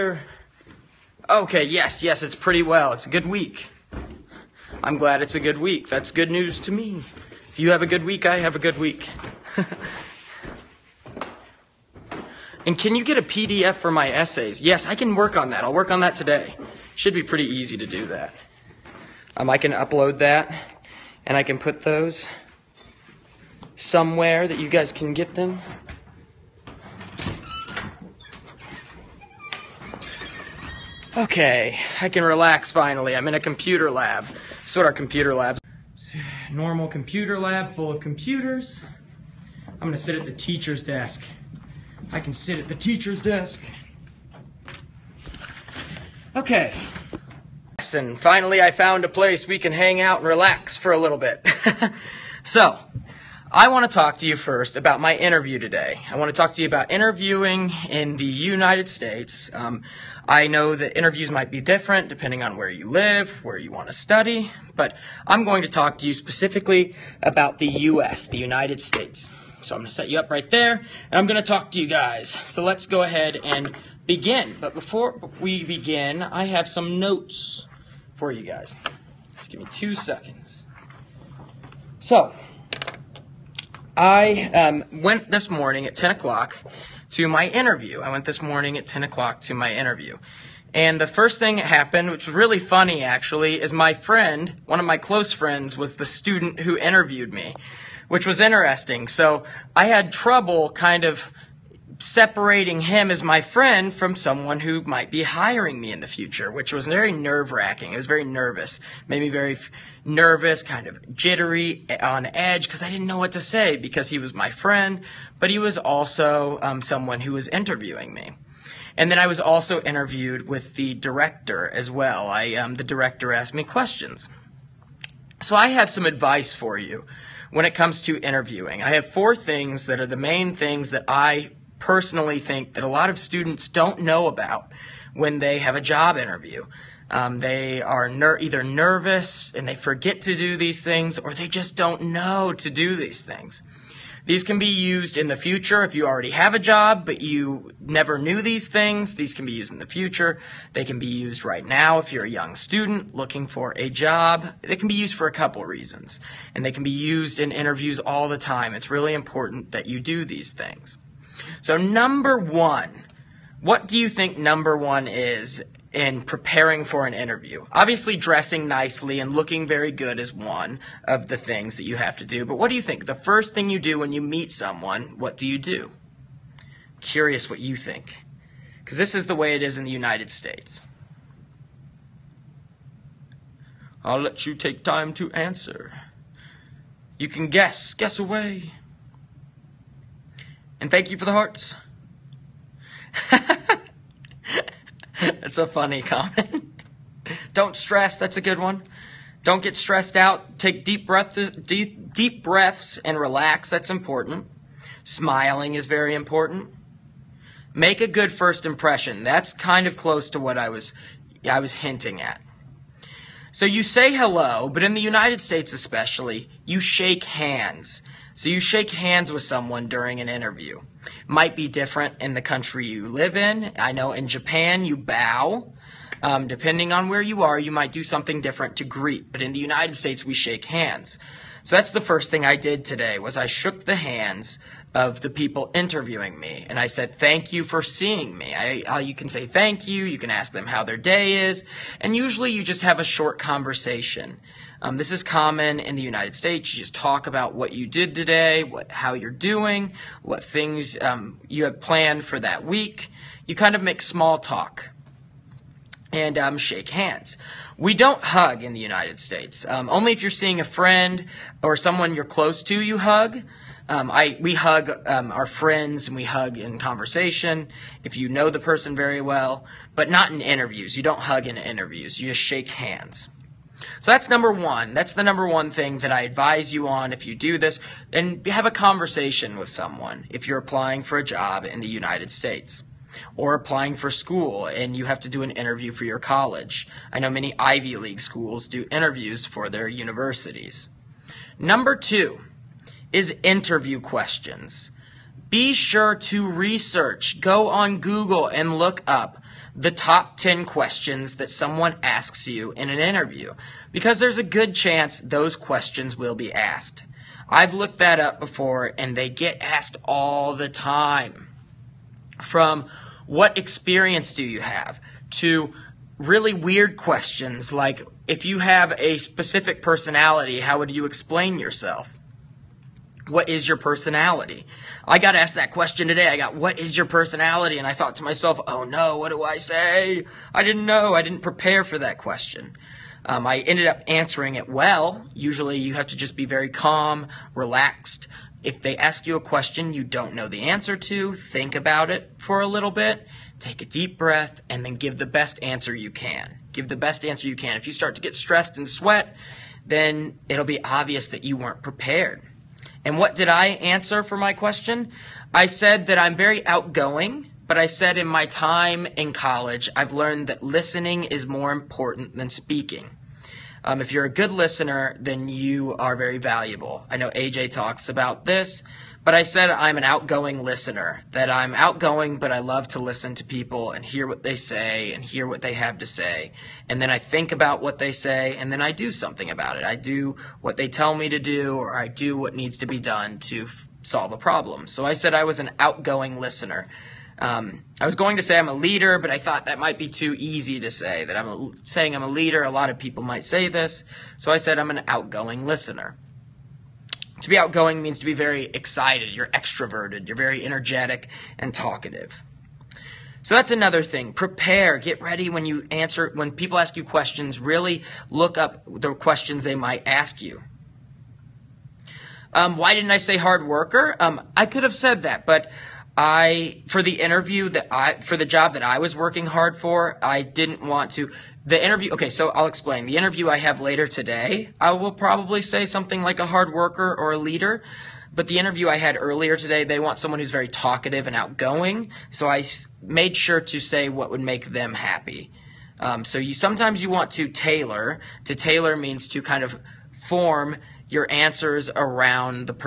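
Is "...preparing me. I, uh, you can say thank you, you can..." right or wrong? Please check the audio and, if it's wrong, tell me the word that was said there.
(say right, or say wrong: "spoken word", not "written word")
wrong: "seeing", not "preparing".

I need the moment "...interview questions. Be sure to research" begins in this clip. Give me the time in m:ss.
4:53.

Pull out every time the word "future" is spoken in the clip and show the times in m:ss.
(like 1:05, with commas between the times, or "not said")
1:46, 2:25, 2:29.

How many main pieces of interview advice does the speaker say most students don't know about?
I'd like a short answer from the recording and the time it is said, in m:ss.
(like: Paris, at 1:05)
4, at 2:09.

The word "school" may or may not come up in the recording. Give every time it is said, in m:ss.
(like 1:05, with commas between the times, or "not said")
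4:44, 4:48.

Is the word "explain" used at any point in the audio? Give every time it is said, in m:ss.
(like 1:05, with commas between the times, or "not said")
5:21, 7:02.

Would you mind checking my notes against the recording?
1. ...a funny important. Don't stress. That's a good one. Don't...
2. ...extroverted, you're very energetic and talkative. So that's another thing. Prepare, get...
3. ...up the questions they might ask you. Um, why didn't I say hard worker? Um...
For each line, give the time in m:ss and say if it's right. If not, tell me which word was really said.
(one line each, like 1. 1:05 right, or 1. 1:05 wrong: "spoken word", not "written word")
1. 3:15 wrong: "comment", not "important"
2. 6:39 right
3. 6:48 right.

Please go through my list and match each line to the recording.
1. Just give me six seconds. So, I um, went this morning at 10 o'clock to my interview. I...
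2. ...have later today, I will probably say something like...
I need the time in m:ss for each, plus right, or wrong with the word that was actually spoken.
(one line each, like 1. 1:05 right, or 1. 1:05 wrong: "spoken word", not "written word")
1. 1:19 wrong: "two", not "six"
2. 7:03 right.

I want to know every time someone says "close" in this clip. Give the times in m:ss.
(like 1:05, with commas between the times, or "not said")
1:34, 3:29, 4:22.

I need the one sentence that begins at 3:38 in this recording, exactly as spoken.
So you shake hands with someone during an interview.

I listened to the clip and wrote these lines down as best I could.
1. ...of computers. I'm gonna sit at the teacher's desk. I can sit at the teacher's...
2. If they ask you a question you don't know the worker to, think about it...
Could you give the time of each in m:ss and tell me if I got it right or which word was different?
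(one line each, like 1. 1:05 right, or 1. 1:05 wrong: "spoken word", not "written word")
1. 0:37 right
2. 5:38 wrong: "answer", not "worker".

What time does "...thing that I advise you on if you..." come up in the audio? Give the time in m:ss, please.
4:35.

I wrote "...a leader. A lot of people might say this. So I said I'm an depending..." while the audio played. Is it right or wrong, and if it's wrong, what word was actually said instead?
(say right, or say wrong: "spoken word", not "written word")
wrong: "outgoing", not "depending".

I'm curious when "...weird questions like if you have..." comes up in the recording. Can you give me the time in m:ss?
5:16.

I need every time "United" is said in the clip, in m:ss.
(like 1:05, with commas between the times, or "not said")
0:58, 1:08, 2:59, 3:35, 3:49, 4:06, 4:18, 4:41.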